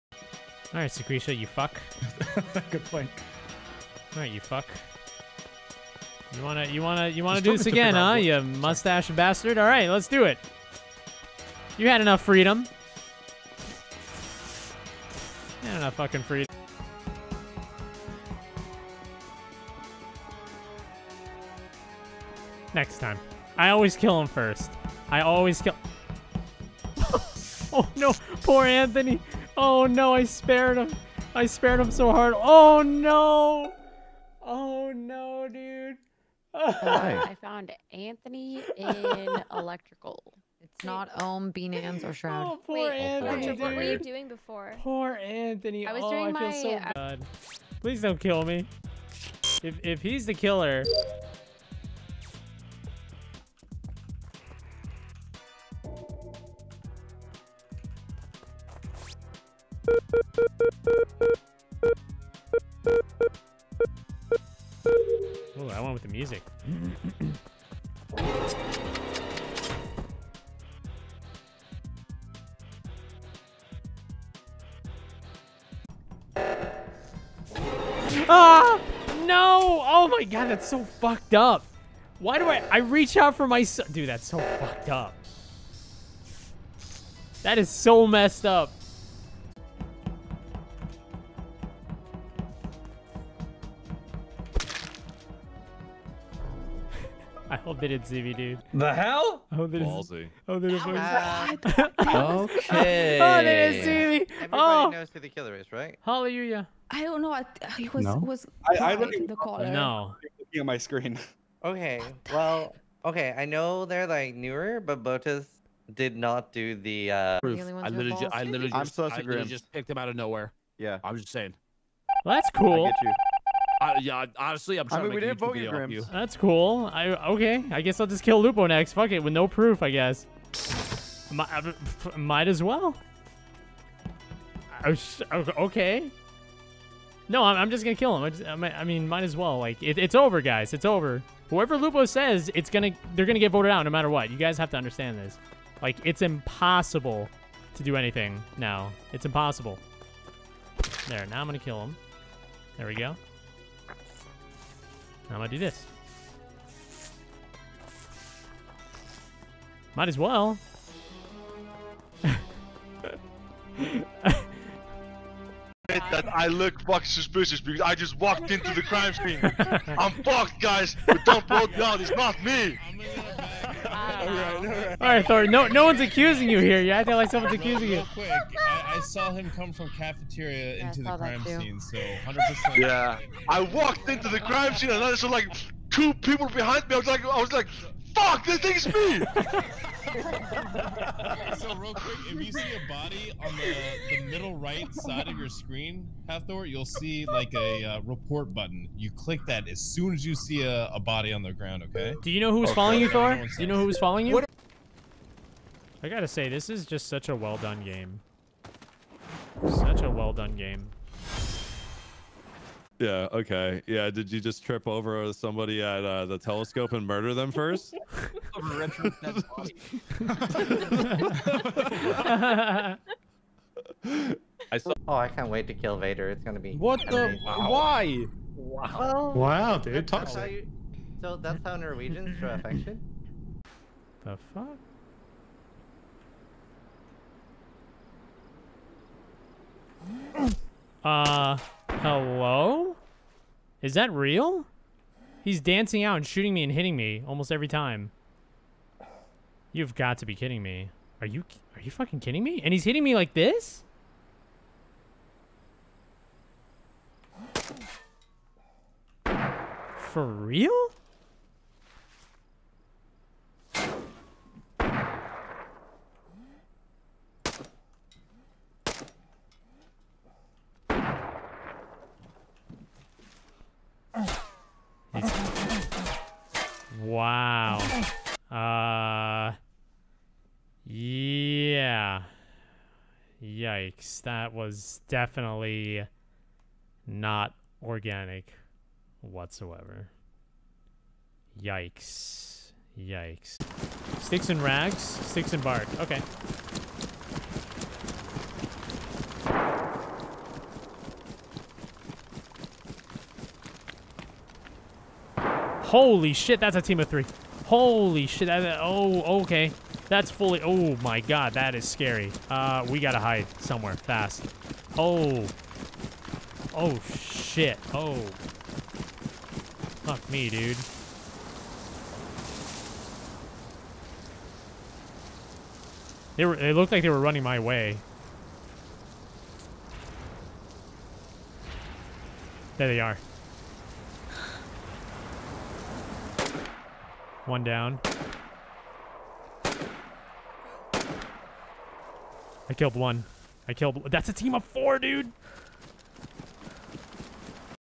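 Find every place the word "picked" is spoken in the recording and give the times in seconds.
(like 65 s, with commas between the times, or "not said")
119 s.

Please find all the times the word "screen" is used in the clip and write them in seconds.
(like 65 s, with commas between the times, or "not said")
110 s, 195 s.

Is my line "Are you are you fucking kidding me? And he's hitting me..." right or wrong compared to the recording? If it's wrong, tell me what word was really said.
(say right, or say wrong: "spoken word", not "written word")
right.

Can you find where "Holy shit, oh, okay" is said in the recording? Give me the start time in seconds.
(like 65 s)
307 s.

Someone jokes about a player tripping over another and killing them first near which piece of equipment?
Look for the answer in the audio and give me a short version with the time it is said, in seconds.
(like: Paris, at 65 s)
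The telescope, at 216 s.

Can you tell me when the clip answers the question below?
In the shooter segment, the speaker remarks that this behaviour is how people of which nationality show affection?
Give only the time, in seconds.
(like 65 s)
231 s.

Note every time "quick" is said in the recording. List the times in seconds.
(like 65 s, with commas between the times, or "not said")
178 s, 191 s.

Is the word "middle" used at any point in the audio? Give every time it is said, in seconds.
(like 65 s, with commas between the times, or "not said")
194 s.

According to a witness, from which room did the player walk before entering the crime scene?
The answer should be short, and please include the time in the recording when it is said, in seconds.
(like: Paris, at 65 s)
Cafeteria, at 179 s.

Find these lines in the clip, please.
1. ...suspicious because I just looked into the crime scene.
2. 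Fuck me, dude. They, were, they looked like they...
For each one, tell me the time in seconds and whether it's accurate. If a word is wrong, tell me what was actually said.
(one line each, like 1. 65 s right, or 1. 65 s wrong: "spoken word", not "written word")
1. 167 s wrong: "walked", not "looked"
2. 320 s right.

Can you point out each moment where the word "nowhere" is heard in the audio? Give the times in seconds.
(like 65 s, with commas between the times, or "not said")
120 s.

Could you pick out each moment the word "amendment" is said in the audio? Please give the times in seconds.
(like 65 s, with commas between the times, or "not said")
not said.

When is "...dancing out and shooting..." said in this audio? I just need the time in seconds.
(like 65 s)
245 s.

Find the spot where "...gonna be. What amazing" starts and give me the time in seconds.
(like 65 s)
226 s.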